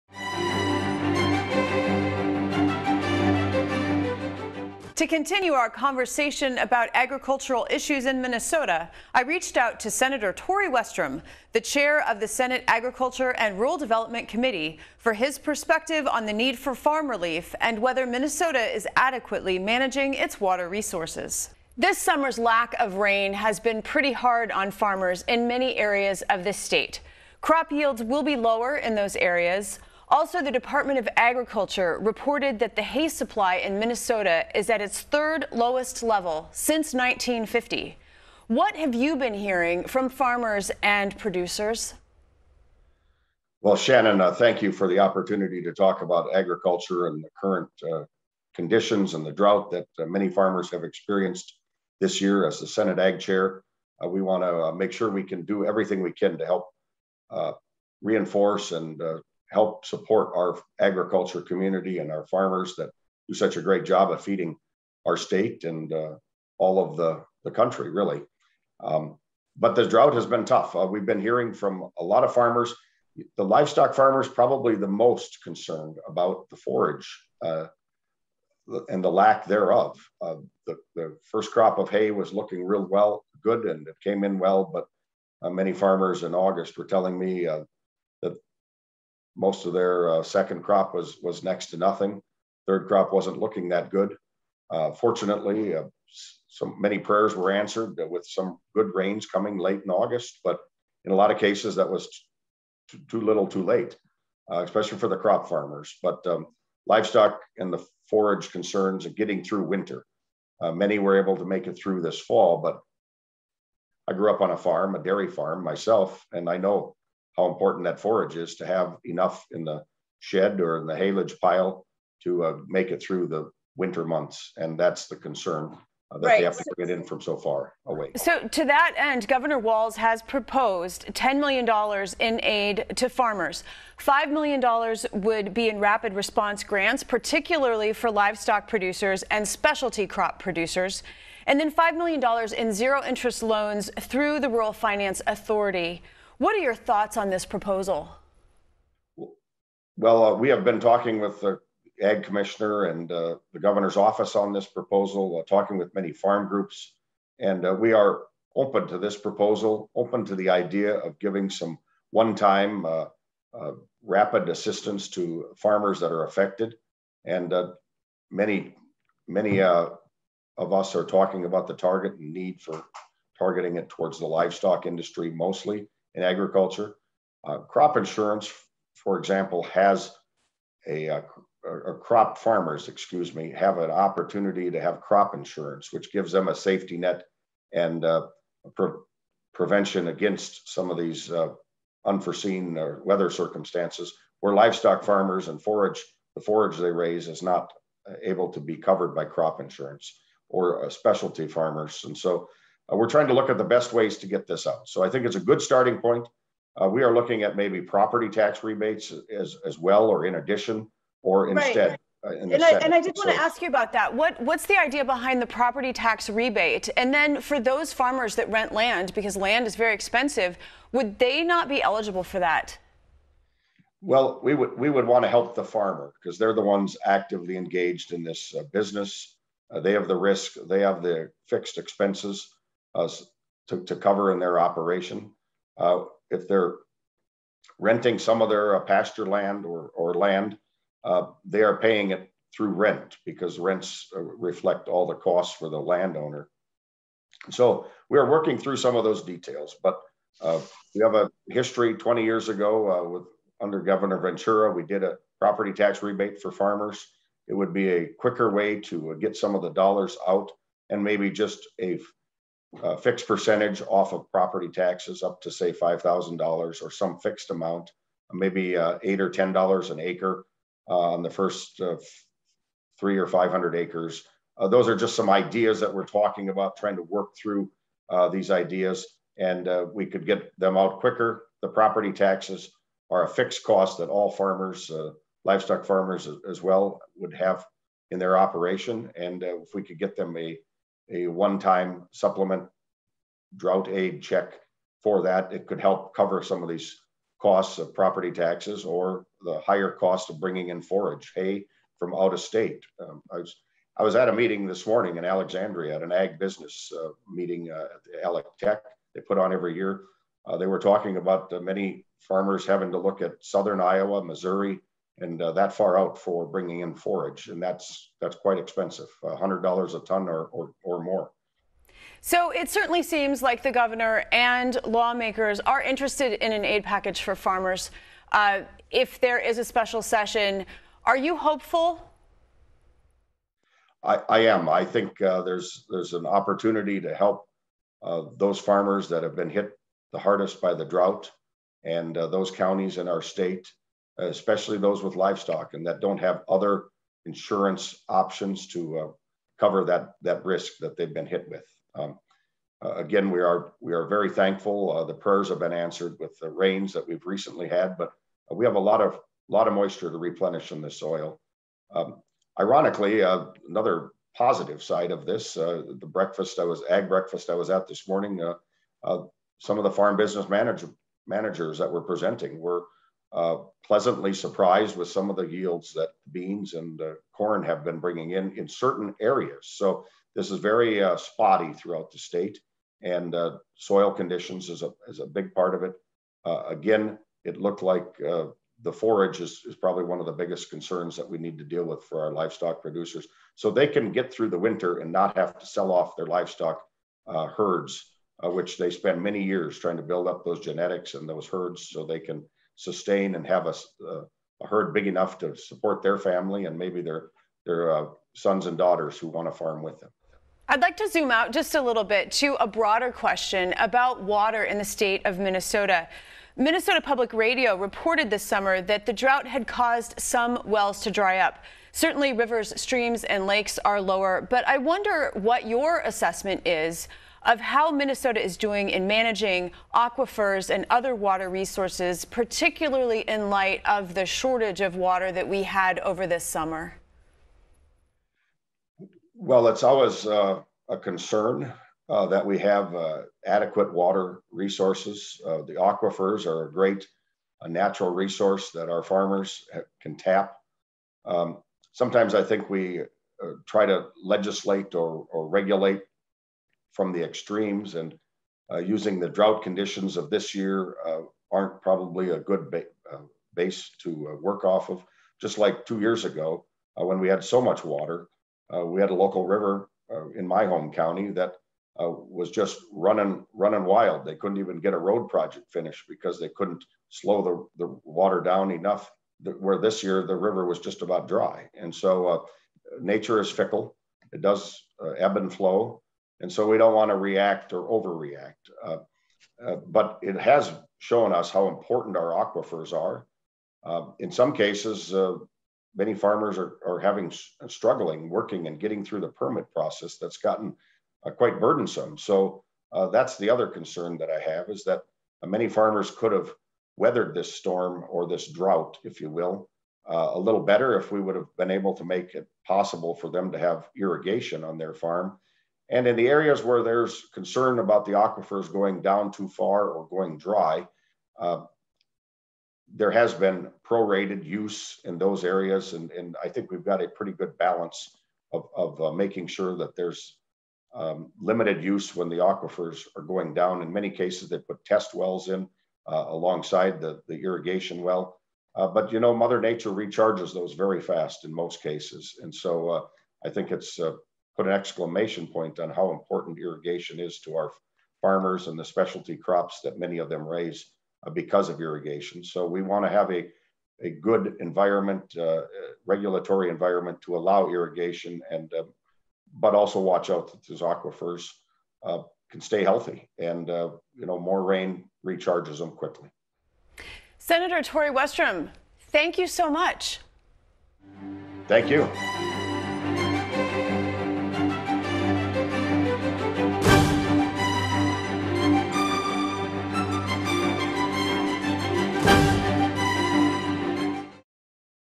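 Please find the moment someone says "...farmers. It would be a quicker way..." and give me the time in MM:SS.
04:16.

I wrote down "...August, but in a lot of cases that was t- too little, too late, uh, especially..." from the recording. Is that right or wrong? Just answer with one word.
right.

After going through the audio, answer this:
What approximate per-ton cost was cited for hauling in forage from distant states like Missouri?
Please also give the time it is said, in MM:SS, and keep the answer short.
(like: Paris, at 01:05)
$100 a ton, at 05:19.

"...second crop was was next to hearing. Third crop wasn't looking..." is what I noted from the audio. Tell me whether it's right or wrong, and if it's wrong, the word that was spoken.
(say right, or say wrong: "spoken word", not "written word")
wrong: "nothing", not "hearing".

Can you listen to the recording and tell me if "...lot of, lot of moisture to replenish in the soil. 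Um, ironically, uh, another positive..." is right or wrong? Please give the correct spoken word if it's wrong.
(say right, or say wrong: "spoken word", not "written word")
right.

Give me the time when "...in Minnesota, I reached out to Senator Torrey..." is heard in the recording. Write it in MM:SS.
00:08.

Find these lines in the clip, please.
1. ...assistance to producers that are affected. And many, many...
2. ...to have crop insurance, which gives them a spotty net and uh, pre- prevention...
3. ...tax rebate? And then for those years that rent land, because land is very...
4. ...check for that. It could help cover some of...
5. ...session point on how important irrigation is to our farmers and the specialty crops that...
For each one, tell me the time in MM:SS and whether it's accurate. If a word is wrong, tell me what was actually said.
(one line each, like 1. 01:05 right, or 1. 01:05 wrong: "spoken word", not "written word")
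1. 02:44 wrong: "farmers", not "producers"
2. 03:04 wrong: "safety", not "spotty"
3. 03:35 wrong: "farmers", not "years"
4. 04:54 right
5. 09:04 wrong: "exclamation", not "session".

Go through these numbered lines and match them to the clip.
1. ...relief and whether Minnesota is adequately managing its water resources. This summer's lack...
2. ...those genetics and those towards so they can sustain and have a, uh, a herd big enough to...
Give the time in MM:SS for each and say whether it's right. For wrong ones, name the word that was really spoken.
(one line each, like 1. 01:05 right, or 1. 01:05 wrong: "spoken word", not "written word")
1. 00:17 right
2. 06:40 wrong: "herds", not "towards".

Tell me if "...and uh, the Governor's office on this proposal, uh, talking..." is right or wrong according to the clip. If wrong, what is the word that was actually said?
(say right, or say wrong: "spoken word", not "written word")
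right.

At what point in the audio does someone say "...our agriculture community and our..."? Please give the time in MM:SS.
01:00.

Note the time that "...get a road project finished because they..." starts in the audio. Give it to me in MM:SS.
07:54.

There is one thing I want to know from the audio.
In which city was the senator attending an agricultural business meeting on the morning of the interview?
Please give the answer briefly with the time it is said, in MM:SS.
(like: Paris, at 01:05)
Alexandria, at 05:05.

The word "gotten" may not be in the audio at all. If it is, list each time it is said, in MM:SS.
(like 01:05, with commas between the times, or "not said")
08:20.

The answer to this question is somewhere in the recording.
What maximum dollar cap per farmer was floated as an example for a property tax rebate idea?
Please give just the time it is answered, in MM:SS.
04:25.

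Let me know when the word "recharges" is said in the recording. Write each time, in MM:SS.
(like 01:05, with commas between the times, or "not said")
08:59, 09:25.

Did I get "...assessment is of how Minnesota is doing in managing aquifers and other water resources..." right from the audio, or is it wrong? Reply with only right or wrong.
right.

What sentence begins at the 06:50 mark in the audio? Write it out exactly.
I'd like to zoom out just a little bit to a broader question about water in the state of Minnesota.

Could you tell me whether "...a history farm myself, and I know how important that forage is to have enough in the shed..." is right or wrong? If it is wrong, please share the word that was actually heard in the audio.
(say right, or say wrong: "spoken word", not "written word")
wrong: "dairy", not "history".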